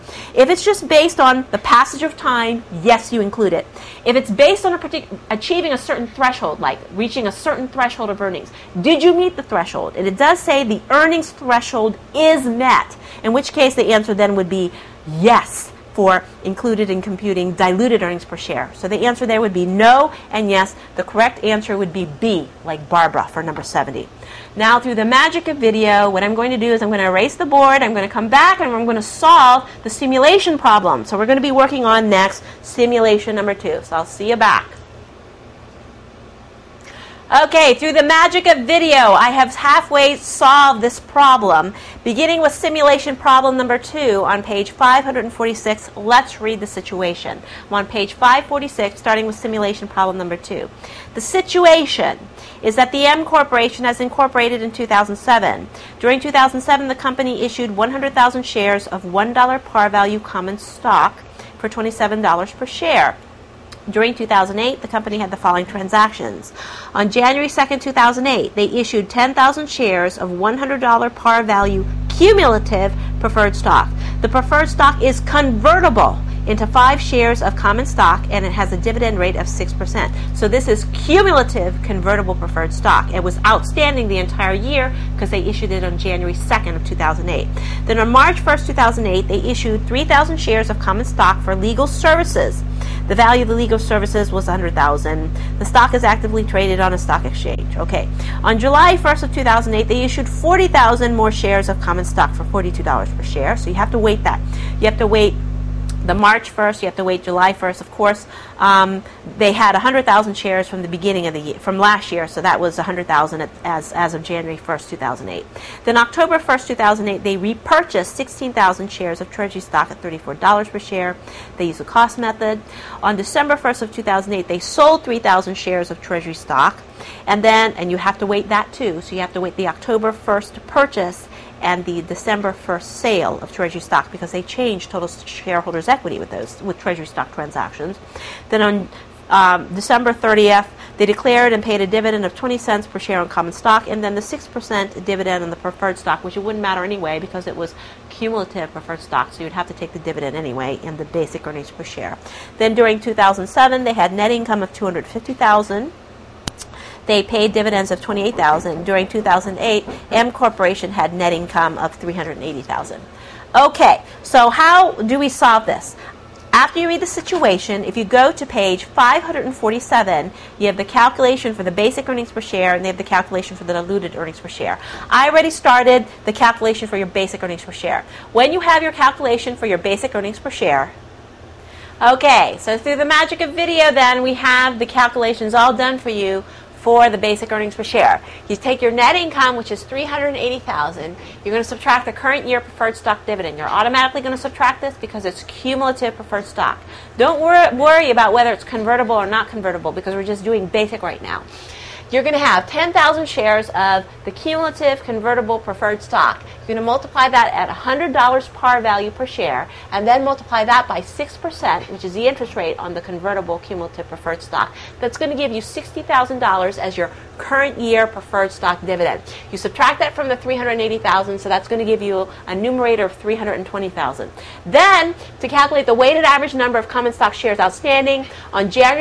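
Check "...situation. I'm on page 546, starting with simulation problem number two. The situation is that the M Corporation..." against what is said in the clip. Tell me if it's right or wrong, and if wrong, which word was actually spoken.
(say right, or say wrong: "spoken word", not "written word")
right.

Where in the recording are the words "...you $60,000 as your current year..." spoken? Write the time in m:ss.
3:35.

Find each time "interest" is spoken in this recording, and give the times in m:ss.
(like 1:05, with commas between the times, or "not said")
3:32.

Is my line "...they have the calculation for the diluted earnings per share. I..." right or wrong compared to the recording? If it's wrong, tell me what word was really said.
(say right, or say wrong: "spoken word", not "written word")
right.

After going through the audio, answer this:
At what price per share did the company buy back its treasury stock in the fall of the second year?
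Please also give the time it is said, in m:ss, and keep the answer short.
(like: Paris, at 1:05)
$34, at 2:00.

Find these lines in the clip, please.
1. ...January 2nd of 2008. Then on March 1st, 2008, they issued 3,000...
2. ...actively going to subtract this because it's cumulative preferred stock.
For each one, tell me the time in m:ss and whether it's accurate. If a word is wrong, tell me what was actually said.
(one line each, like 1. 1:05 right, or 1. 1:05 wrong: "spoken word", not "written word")
1. 1:25 right
2. 3:13 wrong: "automatically", not "actively".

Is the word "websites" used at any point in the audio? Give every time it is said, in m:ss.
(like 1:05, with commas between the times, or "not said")
not said.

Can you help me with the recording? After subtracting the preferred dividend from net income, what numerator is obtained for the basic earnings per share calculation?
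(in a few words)
320,000.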